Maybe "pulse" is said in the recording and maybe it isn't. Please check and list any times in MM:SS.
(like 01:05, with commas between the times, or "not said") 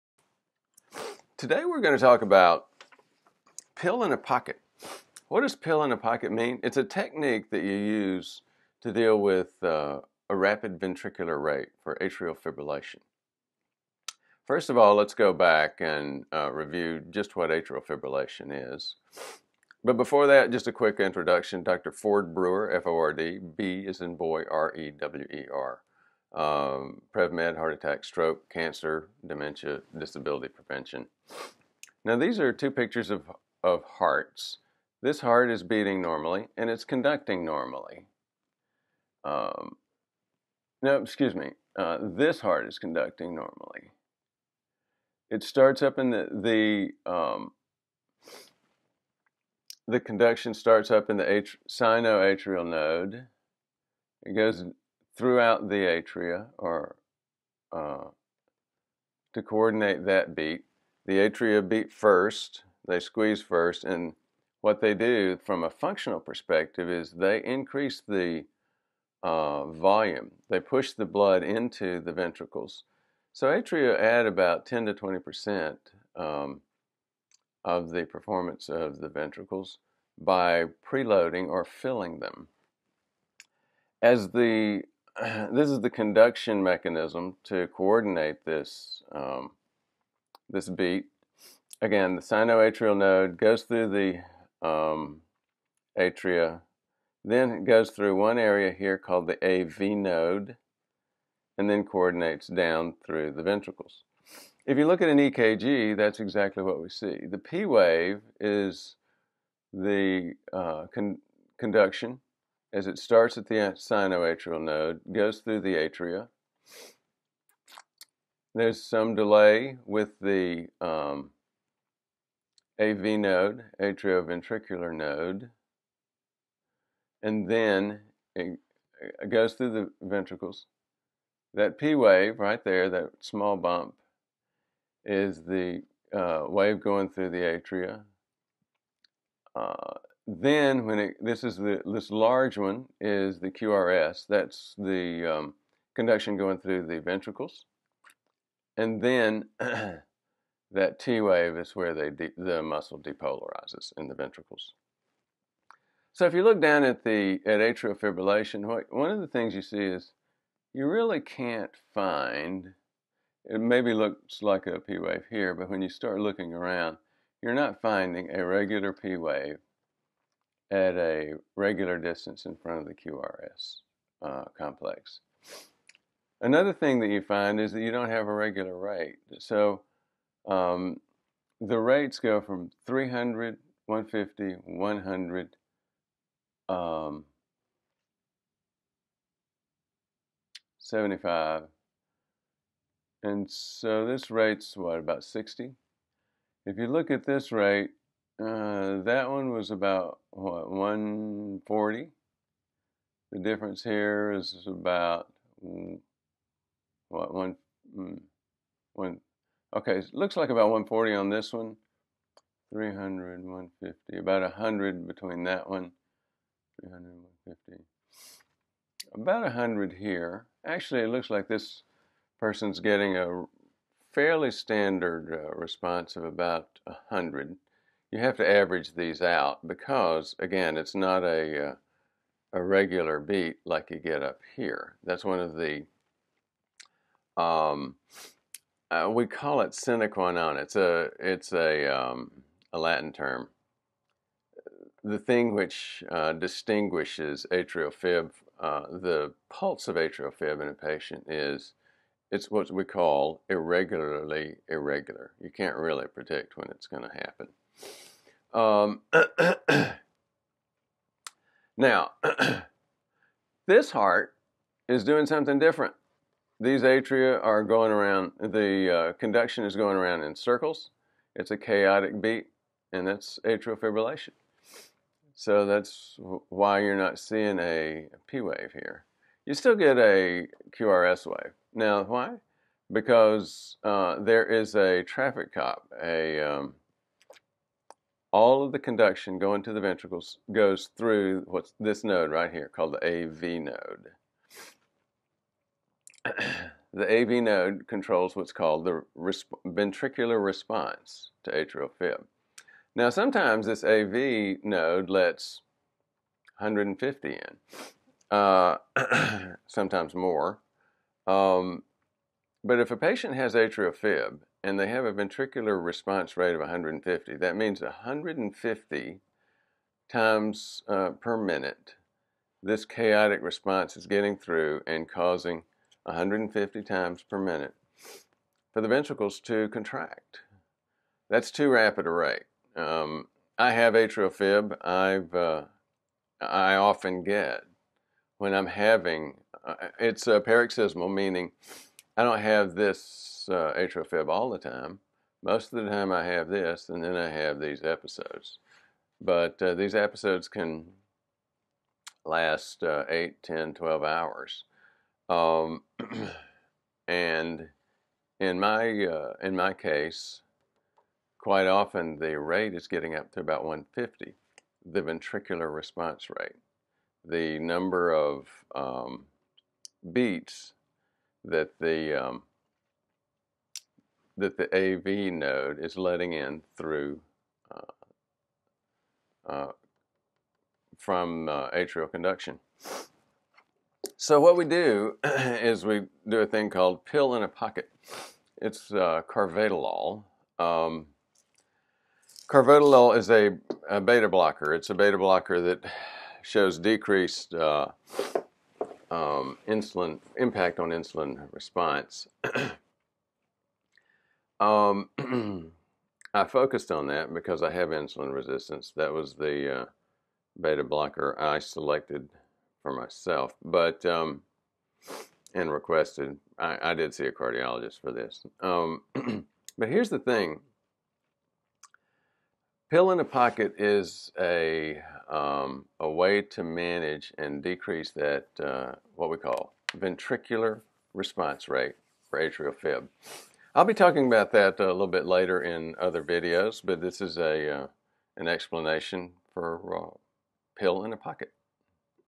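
04:09.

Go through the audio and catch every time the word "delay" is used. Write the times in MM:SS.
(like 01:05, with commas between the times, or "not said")
01:59.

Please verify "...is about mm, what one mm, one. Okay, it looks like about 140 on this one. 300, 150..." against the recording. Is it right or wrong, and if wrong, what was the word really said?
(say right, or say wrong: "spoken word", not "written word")
right.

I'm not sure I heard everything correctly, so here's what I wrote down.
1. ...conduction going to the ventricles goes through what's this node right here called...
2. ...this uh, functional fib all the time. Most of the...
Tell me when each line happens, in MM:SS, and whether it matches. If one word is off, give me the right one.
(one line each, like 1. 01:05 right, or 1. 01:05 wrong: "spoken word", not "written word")
1. 04:48 right
2. 05:42 wrong: "atrial", not "functional".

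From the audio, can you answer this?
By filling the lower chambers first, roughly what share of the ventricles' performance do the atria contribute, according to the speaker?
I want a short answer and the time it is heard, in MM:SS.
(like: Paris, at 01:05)
10 to 20 percent, at 01:14.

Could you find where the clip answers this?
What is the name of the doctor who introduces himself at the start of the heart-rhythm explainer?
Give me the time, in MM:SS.
00:21.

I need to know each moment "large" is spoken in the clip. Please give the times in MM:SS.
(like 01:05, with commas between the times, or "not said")
02:22.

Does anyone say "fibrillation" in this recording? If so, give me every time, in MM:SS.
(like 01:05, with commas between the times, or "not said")
00:12, 00:17, 02:37, 04:33.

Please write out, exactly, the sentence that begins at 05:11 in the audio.
Um, but if a patient has atrial fib and they have a ventricular response rate of 150.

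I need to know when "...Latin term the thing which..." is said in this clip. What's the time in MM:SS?
04:02.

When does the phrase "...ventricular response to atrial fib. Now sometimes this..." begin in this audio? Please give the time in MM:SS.
04:59.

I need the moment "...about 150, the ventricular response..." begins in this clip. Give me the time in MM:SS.
06:03.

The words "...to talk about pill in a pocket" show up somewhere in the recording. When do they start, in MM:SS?
00:01.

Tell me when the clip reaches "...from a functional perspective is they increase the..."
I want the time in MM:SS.
01:05.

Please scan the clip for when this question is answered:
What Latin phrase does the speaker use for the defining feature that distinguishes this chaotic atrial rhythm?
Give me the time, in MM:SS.
03:59.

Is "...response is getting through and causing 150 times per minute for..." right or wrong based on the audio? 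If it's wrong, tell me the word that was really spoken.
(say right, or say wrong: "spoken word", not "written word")
right.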